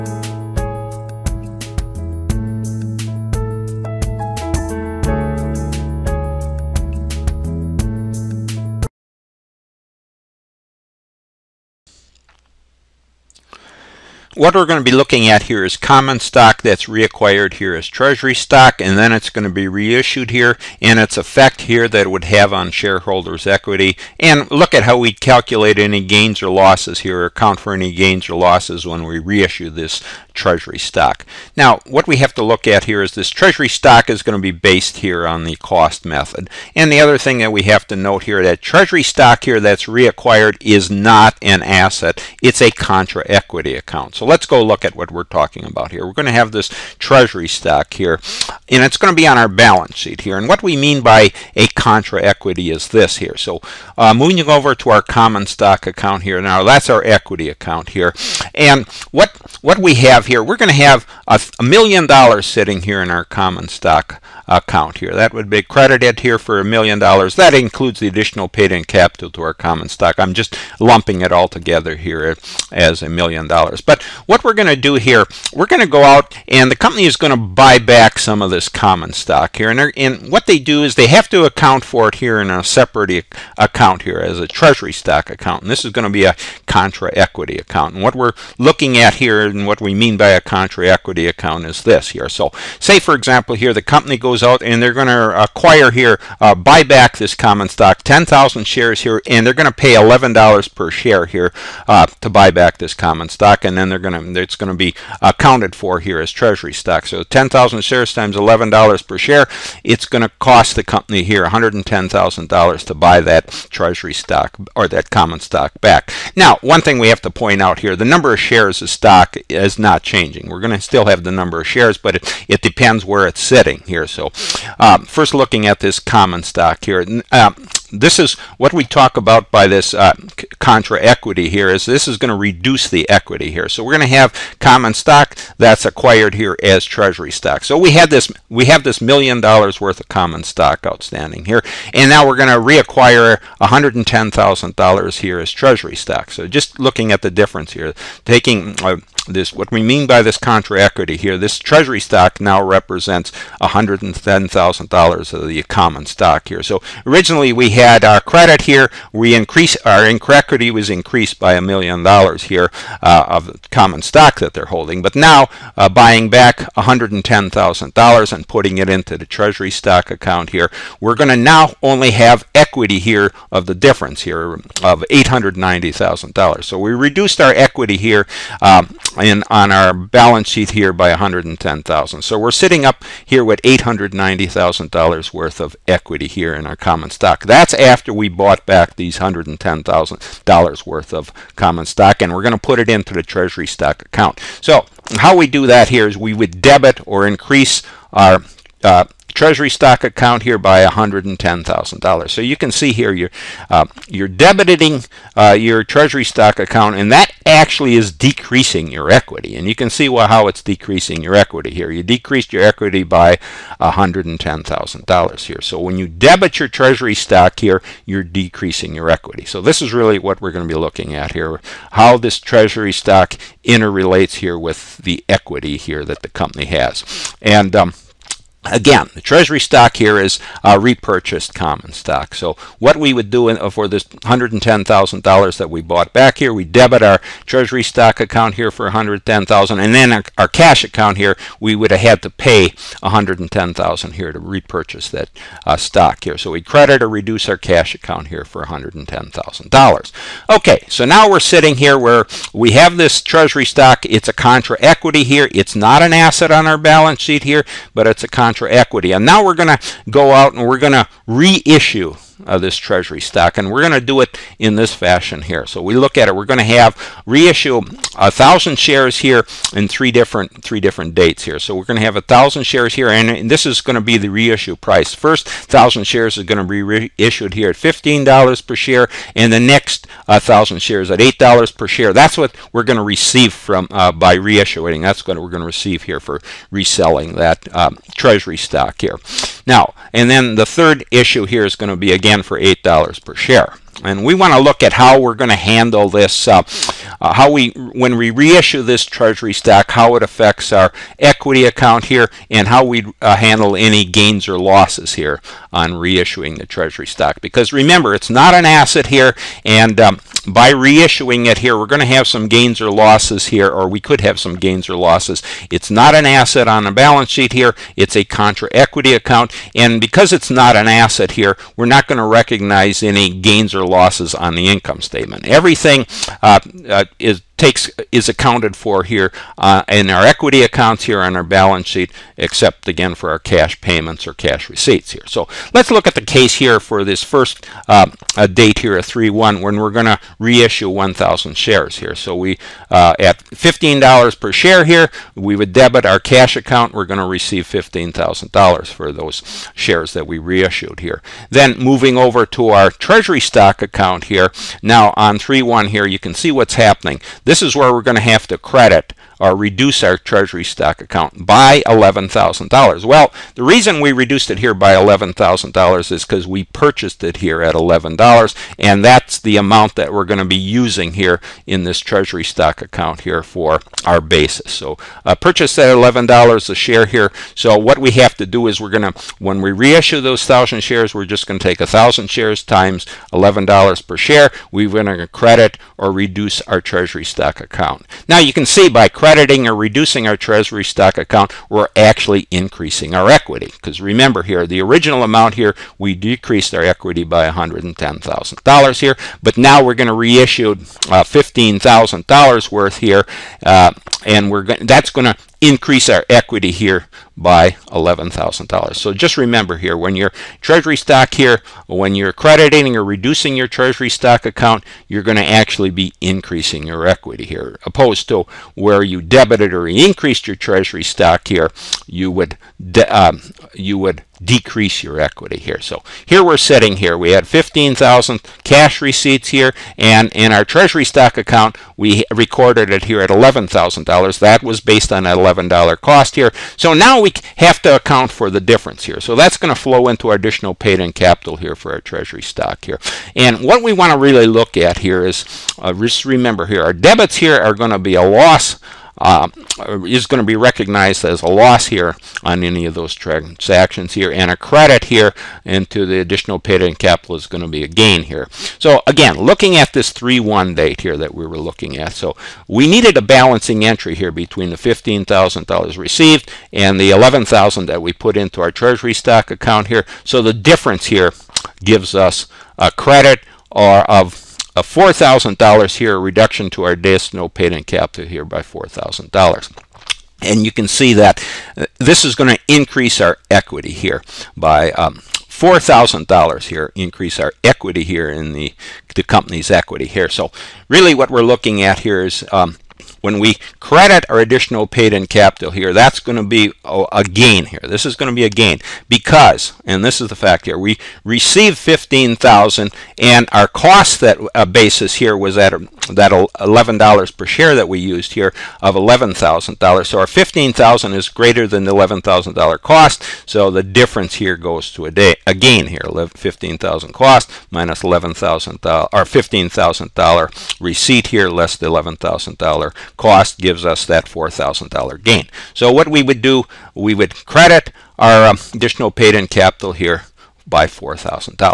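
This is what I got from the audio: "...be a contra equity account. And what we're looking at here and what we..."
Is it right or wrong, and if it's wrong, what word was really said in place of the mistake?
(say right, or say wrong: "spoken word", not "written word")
right.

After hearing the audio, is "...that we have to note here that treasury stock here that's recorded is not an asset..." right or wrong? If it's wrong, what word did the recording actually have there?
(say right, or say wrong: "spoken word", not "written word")
wrong: "reacquired", not "recorded".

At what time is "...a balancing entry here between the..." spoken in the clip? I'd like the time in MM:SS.
07:43.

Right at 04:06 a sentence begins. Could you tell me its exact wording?
So we credit or reduce our cash account here for $110,000.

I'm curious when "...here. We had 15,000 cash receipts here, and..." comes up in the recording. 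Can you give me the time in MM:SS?
07:06.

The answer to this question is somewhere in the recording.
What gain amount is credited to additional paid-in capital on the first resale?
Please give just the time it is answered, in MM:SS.
08:44.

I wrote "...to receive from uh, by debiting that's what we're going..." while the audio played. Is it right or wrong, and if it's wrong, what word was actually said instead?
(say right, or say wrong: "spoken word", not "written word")
wrong: "reissuing", not "debiting".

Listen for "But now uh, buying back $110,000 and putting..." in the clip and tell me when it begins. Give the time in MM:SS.
02:45.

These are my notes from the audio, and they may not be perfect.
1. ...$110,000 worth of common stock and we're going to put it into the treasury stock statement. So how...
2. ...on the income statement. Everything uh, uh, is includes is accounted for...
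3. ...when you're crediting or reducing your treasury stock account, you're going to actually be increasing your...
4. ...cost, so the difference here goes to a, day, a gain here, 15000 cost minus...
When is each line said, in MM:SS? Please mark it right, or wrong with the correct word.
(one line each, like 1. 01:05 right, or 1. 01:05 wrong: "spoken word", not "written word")
1. 03:09 wrong: "account", not "statement"
2. 05:24 wrong: "takes", not "includes"
3. 06:51 right
4. 08:32 right.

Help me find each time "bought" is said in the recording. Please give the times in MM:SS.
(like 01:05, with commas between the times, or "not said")
03:08, 03:55.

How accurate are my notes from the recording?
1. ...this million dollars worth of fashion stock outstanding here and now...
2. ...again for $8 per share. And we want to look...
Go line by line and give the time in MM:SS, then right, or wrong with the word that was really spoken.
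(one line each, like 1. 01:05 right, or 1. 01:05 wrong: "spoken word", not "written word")
1. 02:18 wrong: "common", not "fashion"
2. 04:52 right.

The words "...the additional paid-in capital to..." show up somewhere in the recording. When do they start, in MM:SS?
01:07.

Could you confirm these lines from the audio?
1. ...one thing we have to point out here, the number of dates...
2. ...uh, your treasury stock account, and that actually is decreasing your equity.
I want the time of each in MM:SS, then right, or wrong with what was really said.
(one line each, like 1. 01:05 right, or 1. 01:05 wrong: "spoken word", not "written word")
1. 01:56 wrong: "shares", not "dates"
2. 03:25 right.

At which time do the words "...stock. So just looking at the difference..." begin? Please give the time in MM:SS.
02:25.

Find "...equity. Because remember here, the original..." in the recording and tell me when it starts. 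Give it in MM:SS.
06:33.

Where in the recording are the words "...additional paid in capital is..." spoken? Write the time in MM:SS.
07:36.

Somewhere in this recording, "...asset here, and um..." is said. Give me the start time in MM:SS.
05:08.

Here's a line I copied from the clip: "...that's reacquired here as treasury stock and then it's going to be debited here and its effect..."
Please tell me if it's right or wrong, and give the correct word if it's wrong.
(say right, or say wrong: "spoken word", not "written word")
wrong: "reissued", not "debited".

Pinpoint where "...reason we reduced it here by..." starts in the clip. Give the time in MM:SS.
06:03.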